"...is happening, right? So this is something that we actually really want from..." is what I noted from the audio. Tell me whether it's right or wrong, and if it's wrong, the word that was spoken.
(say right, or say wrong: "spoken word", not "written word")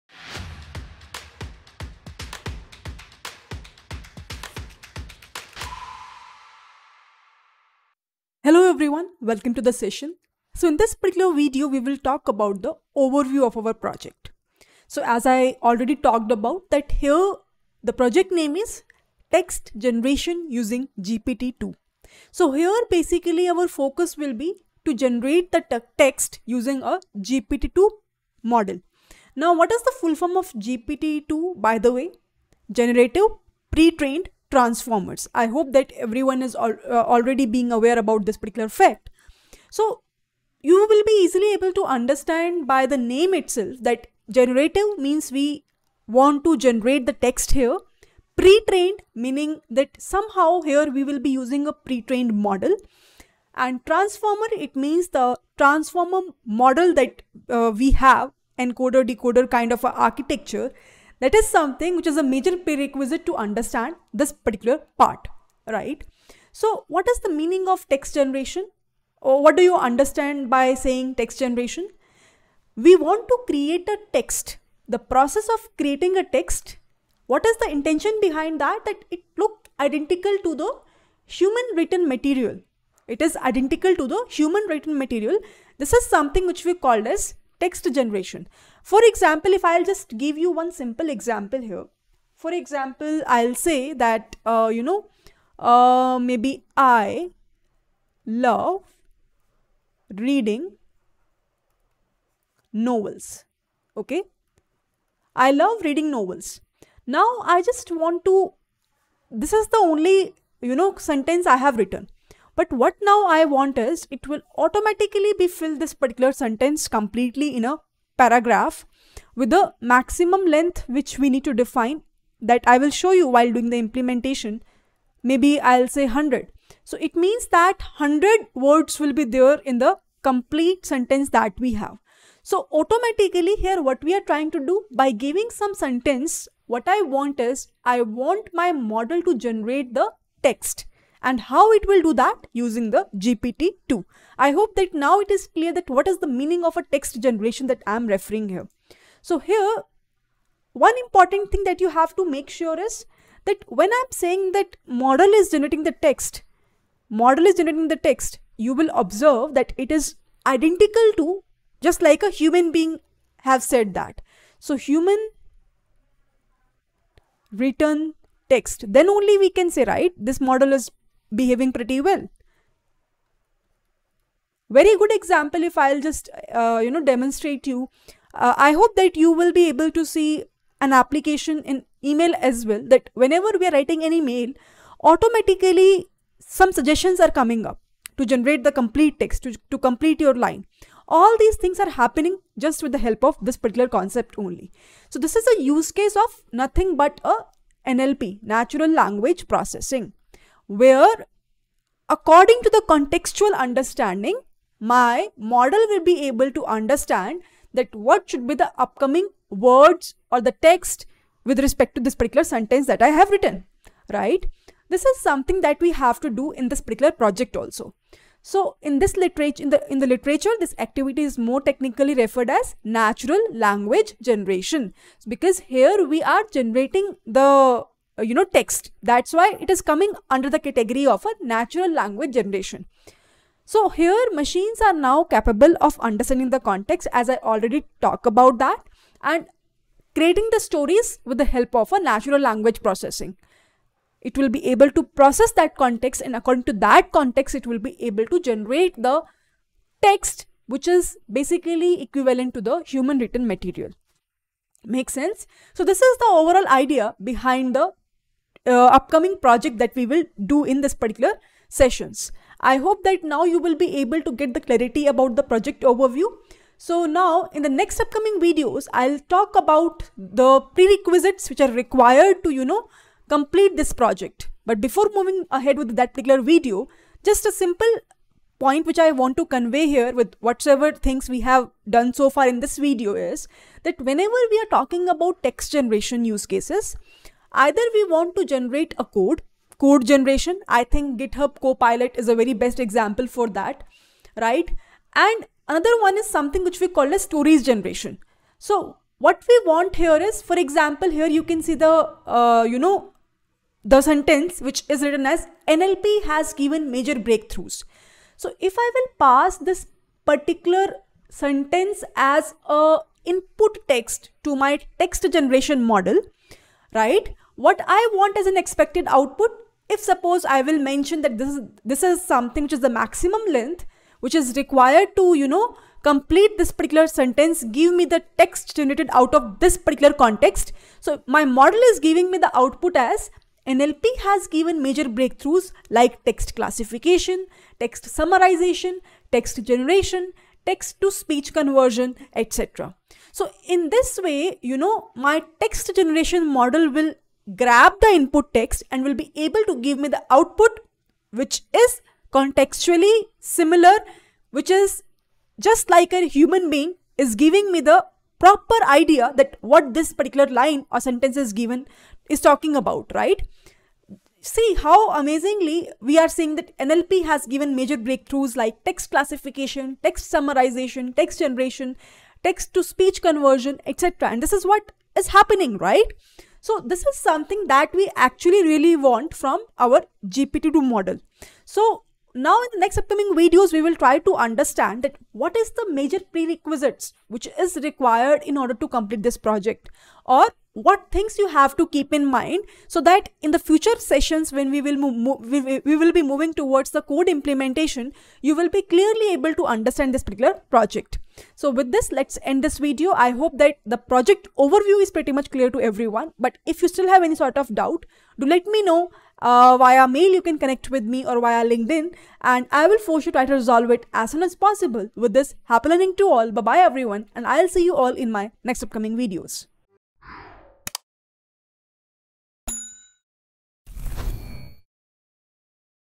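right.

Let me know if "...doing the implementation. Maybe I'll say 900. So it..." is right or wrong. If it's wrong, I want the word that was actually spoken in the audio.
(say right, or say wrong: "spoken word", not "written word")
wrong: "100", not "900".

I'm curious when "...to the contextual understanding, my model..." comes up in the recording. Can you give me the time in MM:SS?
03:22.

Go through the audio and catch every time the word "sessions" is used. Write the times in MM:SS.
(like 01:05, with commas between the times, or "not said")
00:09, 04:21, 06:33.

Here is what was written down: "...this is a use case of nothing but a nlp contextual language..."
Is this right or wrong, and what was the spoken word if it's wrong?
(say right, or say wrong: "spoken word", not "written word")
wrong: "natural", not "contextual".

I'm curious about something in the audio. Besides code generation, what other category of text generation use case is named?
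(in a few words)
Stories generation.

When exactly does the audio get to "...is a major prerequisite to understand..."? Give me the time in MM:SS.
01:02.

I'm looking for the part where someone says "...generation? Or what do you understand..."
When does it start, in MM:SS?
01:08.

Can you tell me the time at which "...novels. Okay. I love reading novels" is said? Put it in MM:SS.
01:42.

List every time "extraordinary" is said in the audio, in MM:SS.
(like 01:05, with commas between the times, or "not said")
not said.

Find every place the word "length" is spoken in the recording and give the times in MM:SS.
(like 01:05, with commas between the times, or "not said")
02:00, 05:23.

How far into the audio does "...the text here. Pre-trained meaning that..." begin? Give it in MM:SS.
00:47.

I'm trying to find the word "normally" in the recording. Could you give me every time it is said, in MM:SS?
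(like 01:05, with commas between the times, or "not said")
not said.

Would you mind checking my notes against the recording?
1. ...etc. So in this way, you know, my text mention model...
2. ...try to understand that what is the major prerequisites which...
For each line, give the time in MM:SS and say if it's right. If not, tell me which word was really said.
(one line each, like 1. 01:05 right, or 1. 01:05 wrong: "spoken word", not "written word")
1. 05:42 wrong: "generation", not "mention"
2. 06:23 right.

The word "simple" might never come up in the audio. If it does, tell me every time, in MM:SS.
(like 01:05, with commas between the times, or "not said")
01:30, 04:37.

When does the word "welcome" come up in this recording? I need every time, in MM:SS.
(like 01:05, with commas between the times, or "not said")
00:09.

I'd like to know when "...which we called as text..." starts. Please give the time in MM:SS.
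01:26.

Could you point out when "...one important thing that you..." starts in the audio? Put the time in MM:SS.
02:30.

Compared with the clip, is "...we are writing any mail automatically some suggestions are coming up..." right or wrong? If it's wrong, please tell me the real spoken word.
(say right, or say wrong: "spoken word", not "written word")
right.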